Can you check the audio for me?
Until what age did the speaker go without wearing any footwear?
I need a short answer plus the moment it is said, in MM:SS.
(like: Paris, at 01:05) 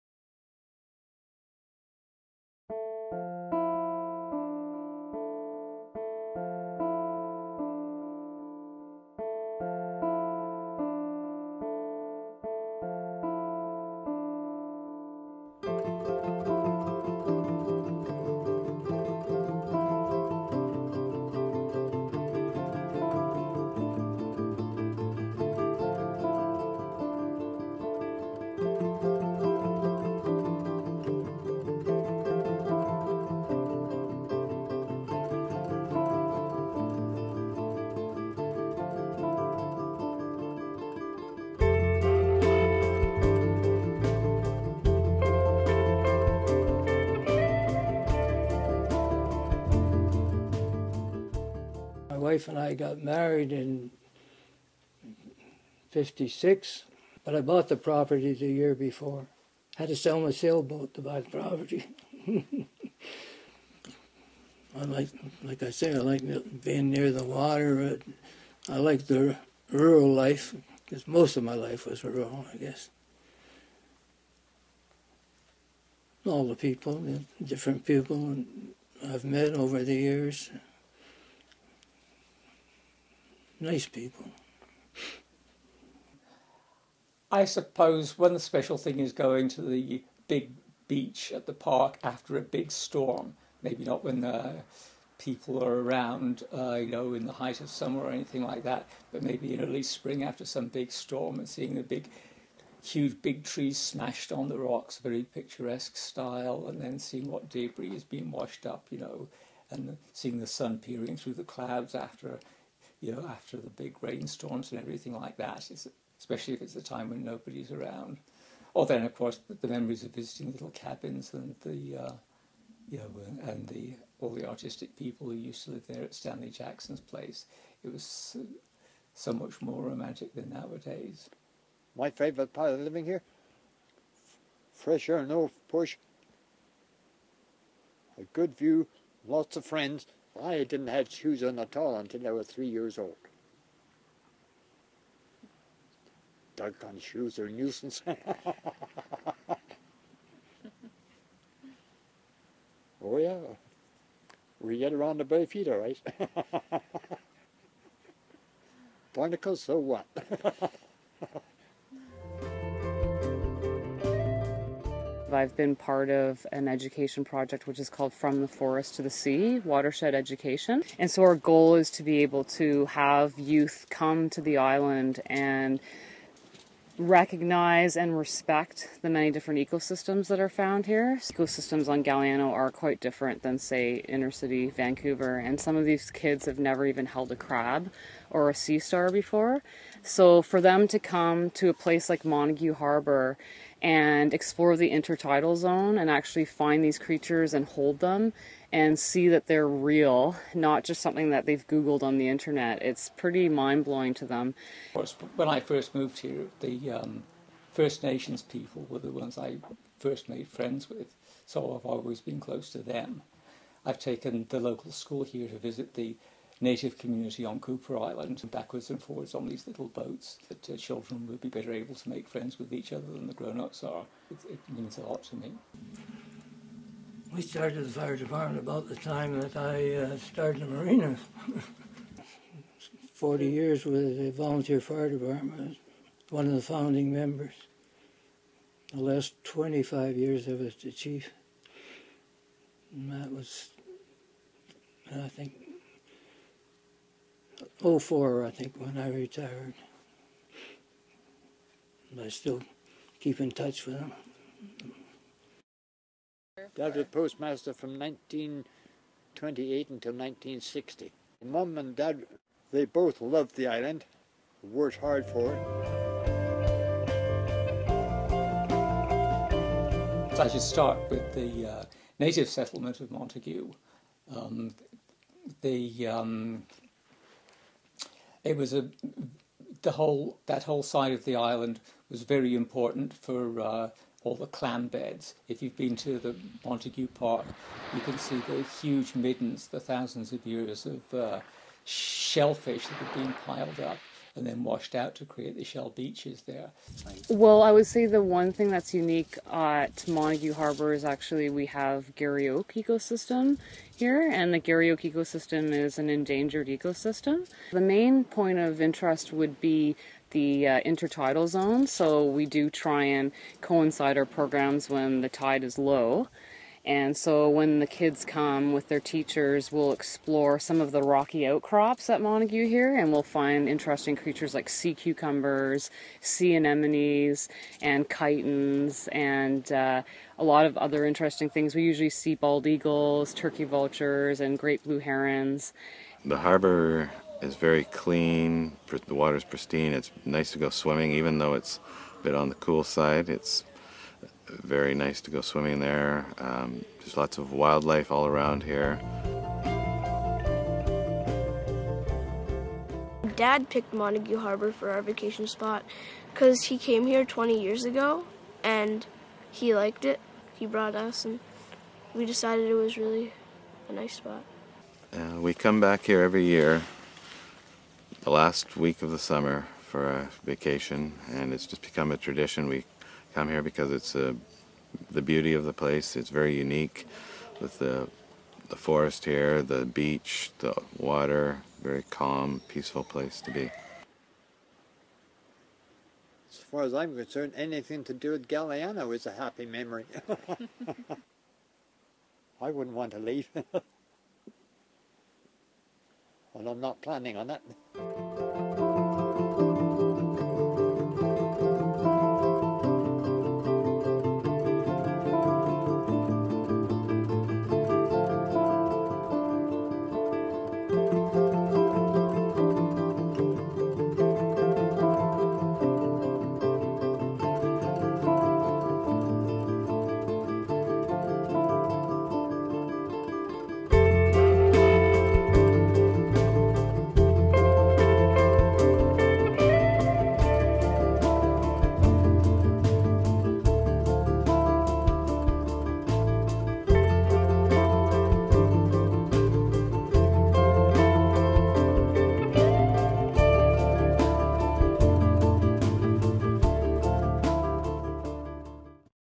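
3, at 02:22.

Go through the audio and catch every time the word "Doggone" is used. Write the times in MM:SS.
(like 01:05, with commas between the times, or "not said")
02:26.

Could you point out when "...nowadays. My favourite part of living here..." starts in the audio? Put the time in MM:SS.
02:10.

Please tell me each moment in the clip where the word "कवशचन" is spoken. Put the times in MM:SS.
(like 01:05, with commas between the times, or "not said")
not said.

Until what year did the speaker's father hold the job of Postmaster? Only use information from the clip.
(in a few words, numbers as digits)
1960.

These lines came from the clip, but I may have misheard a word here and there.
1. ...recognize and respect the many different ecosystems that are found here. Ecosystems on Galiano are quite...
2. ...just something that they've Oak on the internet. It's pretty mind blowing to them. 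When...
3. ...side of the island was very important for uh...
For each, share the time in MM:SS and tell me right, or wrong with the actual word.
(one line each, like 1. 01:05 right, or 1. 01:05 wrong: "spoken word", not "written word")
1. 02:56 right
2. 03:20 wrong: "Googled", not "Oak"
3. 04:40 right.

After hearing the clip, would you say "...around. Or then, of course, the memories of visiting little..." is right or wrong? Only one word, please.
right.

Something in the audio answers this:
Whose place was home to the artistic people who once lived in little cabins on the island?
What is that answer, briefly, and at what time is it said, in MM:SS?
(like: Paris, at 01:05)
Stanley Jackson's place, at 02:06.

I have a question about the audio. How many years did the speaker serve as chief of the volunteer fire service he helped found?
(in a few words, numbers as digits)
25.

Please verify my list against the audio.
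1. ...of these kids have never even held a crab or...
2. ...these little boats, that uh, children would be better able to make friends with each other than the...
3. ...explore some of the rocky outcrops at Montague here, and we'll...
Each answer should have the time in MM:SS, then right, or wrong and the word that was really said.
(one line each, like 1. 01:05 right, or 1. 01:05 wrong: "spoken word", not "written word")
1. 03:05 right
2. 03:39 right
3. 05:19 right.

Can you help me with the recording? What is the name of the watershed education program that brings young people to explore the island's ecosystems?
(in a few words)
From the Forest to the Sea.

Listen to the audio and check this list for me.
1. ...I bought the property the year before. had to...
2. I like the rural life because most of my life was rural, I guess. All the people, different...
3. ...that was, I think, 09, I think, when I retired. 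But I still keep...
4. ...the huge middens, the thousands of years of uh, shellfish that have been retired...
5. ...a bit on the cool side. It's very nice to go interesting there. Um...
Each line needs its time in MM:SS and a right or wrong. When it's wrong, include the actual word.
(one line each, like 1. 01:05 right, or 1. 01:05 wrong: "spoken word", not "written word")
1. 00:57 right
2. 01:08 right
3. 04:03 wrong: "04", not "09"
4. 04:48 wrong: "piled", not "retired"
5. 05:42 wrong: "swimming", not "interesting".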